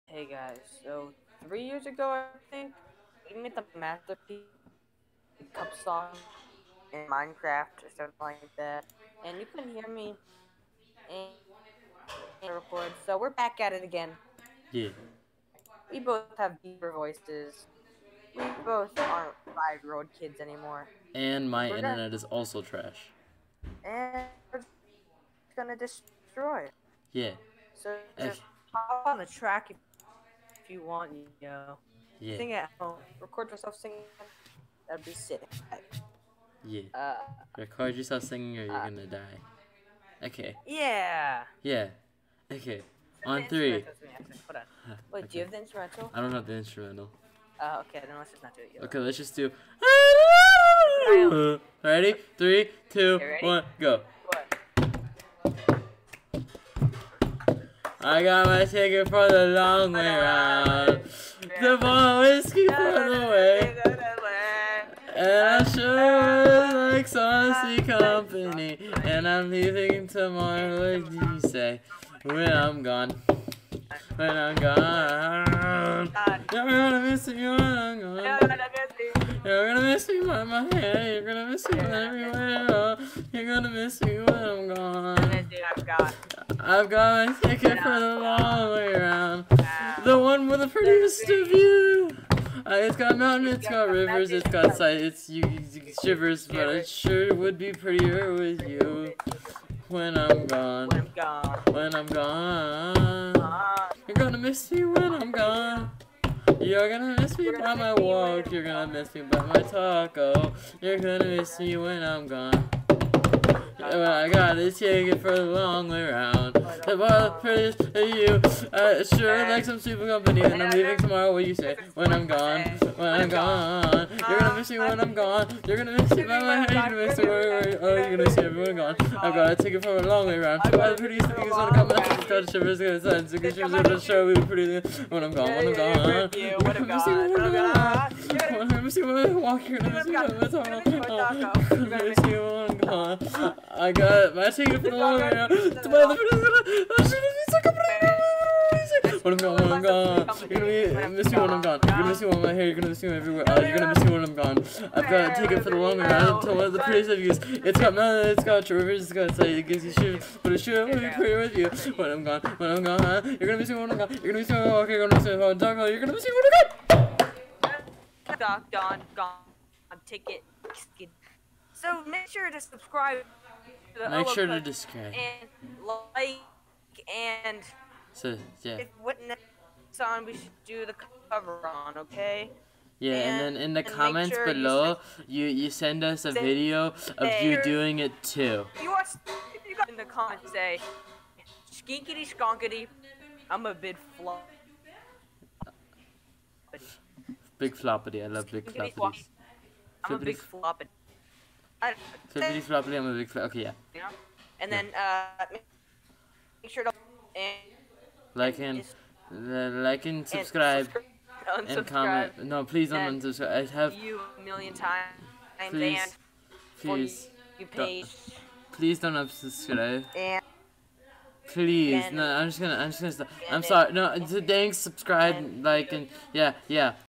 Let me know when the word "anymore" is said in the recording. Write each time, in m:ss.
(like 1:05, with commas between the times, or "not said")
0:20.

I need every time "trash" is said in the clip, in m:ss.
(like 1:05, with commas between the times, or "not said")
0:22.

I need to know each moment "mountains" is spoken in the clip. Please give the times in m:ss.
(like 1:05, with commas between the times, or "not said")
1:33, 2:37.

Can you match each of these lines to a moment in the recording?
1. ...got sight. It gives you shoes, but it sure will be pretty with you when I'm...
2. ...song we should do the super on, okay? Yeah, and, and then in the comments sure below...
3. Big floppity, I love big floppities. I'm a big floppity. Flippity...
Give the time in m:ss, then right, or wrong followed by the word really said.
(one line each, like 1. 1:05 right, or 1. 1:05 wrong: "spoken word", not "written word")
1. 2:39 right
2. 2:59 wrong: "cover", not "super"
3. 3:17 right.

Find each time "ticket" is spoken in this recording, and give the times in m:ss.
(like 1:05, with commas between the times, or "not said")
0:58, 1:27, 1:54, 2:09, 2:24, 2:35, 2:50.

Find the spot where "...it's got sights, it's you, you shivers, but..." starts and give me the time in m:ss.
1:34.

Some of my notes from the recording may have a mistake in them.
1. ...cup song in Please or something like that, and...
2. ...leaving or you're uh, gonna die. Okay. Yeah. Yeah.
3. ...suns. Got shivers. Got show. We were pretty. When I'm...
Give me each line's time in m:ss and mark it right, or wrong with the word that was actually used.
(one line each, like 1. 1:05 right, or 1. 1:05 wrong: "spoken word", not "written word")
1. 0:05 wrong: "Minecraft", not "Please"
2. 0:38 wrong: "singing", not "leaving"
3. 2:13 right.